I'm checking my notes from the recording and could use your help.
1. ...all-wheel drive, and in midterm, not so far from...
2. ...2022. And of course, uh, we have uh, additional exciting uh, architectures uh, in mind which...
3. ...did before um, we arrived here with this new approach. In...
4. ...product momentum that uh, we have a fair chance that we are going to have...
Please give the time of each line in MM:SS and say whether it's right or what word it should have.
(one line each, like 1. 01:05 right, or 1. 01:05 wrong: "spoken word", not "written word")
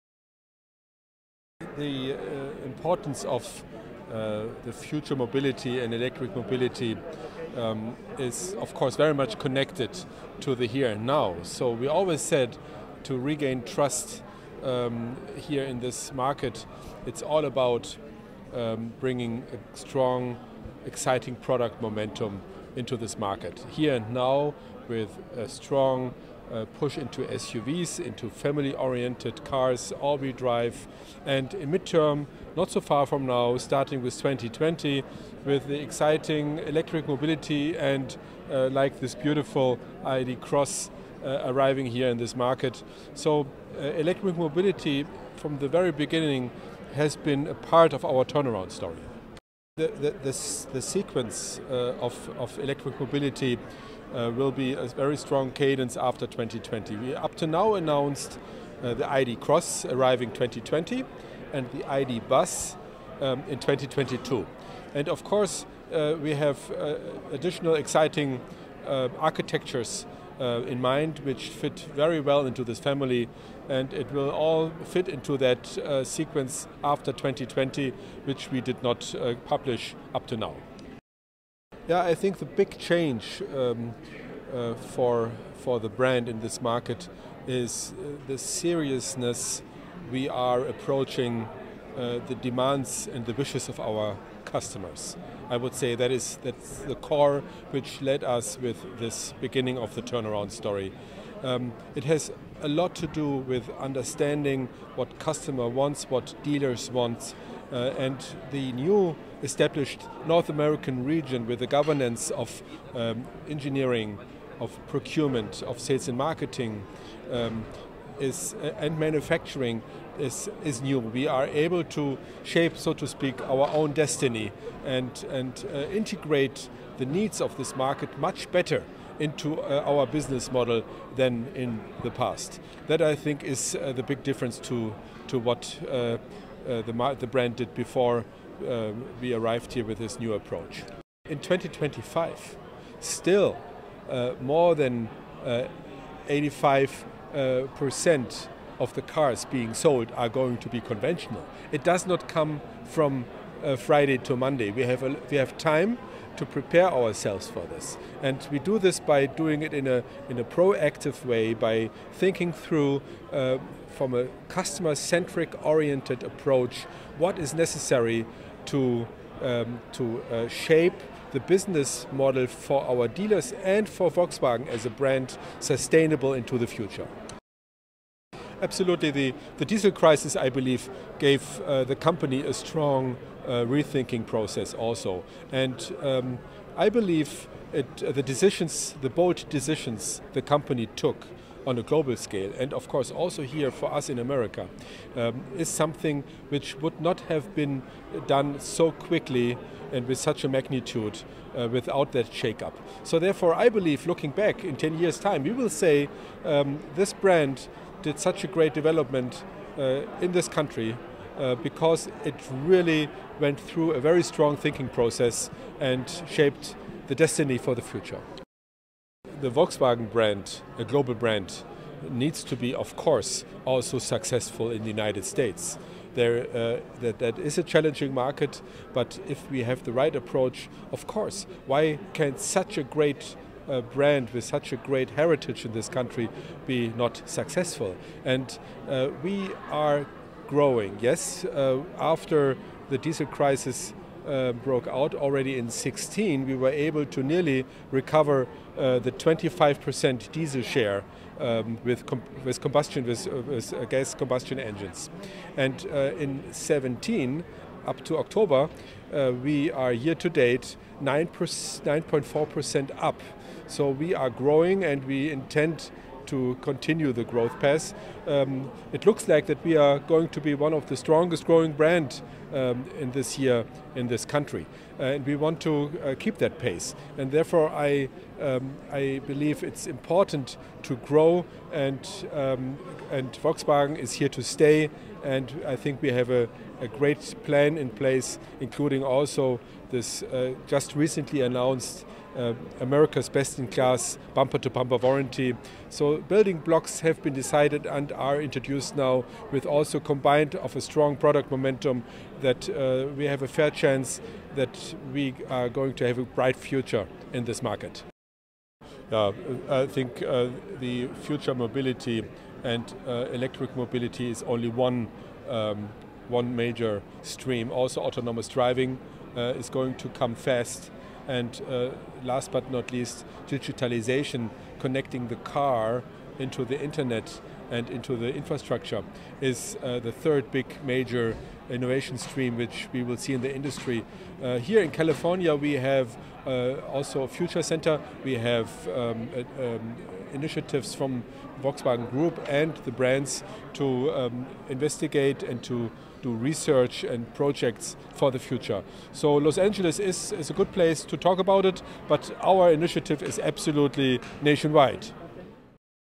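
1. 00:29 right
2. 01:03 right
3. 02:17 right
4. 05:01 right.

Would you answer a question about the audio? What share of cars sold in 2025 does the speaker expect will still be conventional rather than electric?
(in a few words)
More than 85%.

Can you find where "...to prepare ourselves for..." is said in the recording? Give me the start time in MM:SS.
02:36.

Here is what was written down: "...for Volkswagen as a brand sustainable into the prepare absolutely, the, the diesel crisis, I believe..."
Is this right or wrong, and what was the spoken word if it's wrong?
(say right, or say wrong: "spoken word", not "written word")
wrong: "future", not "prepare".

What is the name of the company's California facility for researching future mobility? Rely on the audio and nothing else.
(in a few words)
Future Center.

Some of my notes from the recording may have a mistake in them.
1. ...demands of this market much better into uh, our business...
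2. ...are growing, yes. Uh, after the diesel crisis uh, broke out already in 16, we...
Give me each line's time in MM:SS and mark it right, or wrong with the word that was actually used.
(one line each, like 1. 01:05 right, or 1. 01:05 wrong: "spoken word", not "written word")
1. 02:07 wrong: "needs", not "demands"
2. 03:59 right.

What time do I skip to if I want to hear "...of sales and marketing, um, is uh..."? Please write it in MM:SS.
01:55.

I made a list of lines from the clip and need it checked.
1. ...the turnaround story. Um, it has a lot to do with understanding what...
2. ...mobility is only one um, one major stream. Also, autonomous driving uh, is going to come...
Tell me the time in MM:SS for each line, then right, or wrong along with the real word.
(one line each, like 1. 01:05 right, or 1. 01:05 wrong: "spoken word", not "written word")
1. 01:39 right
2. 05:13 right.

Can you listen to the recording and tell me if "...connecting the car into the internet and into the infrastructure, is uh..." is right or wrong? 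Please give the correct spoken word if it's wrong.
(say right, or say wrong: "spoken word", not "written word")
right.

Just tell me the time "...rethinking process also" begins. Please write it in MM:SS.
03:03.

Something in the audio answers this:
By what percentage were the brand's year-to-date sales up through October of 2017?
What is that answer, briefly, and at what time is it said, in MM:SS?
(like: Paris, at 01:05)
9.4%, at 04:21.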